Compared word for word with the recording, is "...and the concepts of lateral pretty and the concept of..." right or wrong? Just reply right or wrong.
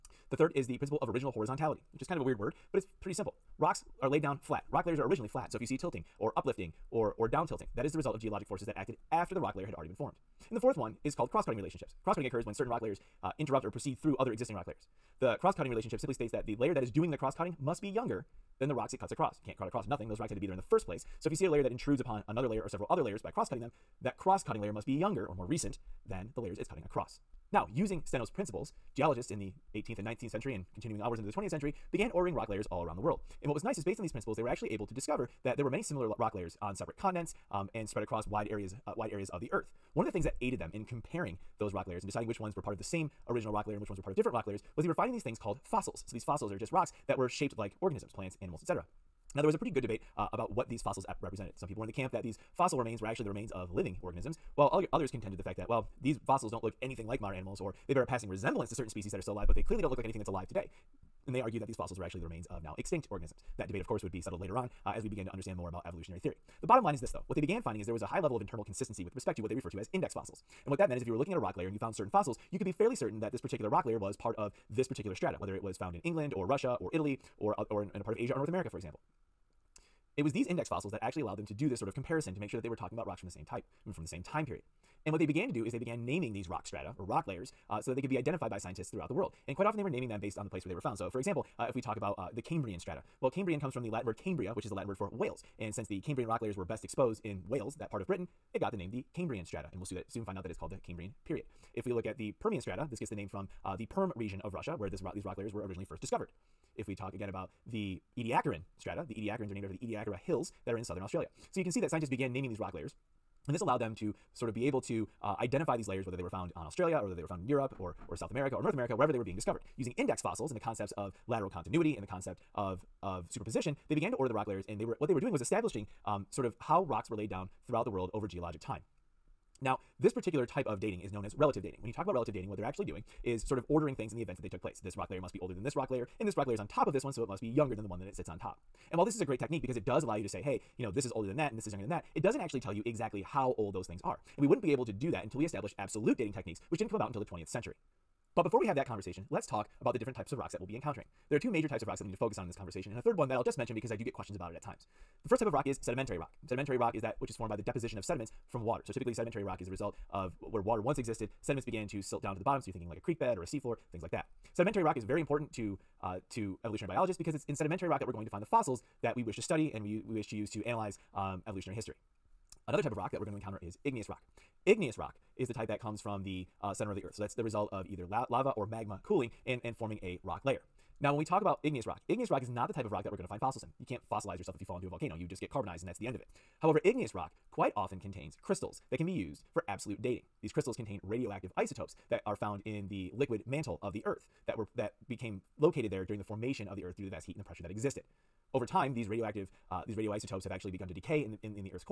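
wrong.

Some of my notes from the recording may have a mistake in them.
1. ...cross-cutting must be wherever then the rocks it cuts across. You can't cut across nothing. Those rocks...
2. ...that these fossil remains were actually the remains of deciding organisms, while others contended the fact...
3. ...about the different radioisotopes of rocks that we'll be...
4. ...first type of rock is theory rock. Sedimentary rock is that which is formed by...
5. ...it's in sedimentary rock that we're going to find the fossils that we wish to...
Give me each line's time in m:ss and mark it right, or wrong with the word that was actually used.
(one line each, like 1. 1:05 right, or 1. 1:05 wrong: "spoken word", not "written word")
1. 0:17 wrong: "younger", not "wherever"
2. 0:52 wrong: "living", not "deciding"
3. 2:29 wrong: "types", not "radioisotopes"
4. 2:35 wrong: "sedimentary", not "theory"
5. 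2:47 right.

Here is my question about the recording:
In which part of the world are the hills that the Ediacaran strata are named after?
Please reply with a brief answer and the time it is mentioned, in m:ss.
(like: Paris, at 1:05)
southern Australia, at 1:50.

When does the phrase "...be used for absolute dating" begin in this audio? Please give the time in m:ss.
3:09.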